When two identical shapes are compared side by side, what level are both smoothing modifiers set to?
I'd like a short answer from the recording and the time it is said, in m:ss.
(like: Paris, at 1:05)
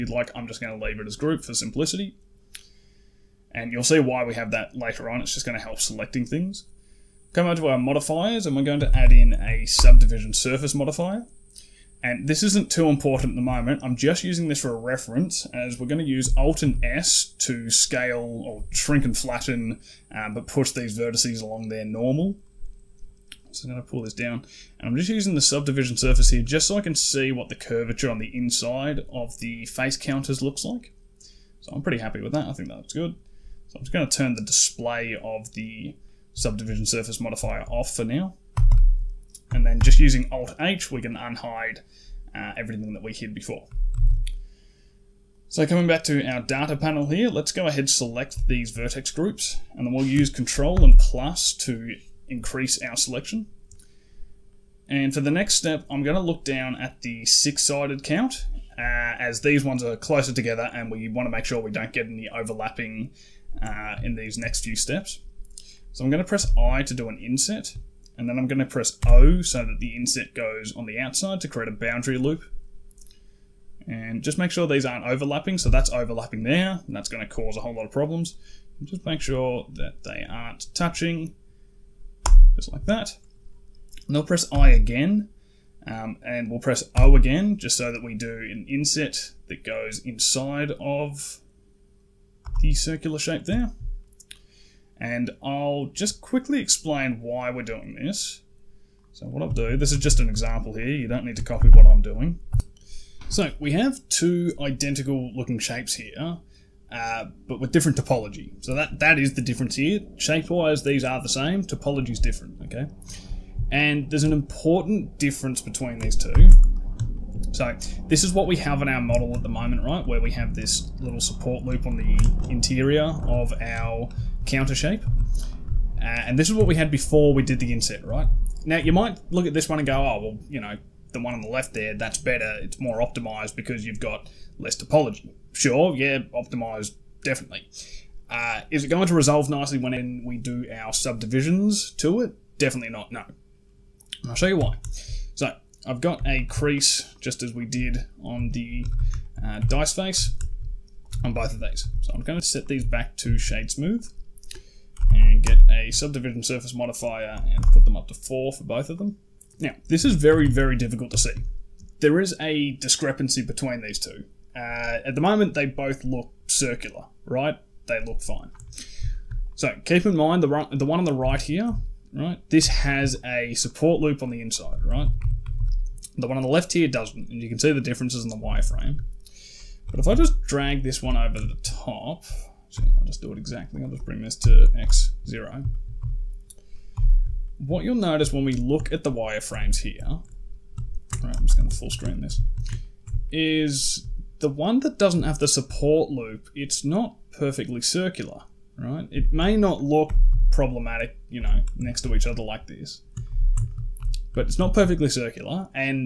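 4, at 2:38.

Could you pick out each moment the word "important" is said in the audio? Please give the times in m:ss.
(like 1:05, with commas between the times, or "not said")
0:12, 1:54.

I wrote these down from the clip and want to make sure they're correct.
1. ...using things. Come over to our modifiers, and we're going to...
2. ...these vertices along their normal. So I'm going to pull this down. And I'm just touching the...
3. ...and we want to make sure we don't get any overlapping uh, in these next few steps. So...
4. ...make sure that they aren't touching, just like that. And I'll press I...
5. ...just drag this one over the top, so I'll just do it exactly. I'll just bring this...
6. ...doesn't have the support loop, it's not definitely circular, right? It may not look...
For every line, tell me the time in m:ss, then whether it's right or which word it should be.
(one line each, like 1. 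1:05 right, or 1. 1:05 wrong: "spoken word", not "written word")
1. 0:05 wrong: "selecting", not "using"
2. 0:20 wrong: "using", not "touching"
3. 1:00 right
4. 1:19 right
5. 3:00 right
6. 3:14 wrong: "perfectly", not "definitely".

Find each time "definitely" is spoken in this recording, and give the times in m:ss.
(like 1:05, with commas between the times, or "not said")
2:17, 2:22.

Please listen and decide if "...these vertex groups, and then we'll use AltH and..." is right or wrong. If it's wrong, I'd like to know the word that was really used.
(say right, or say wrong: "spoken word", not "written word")
wrong: "Control", not "AltH".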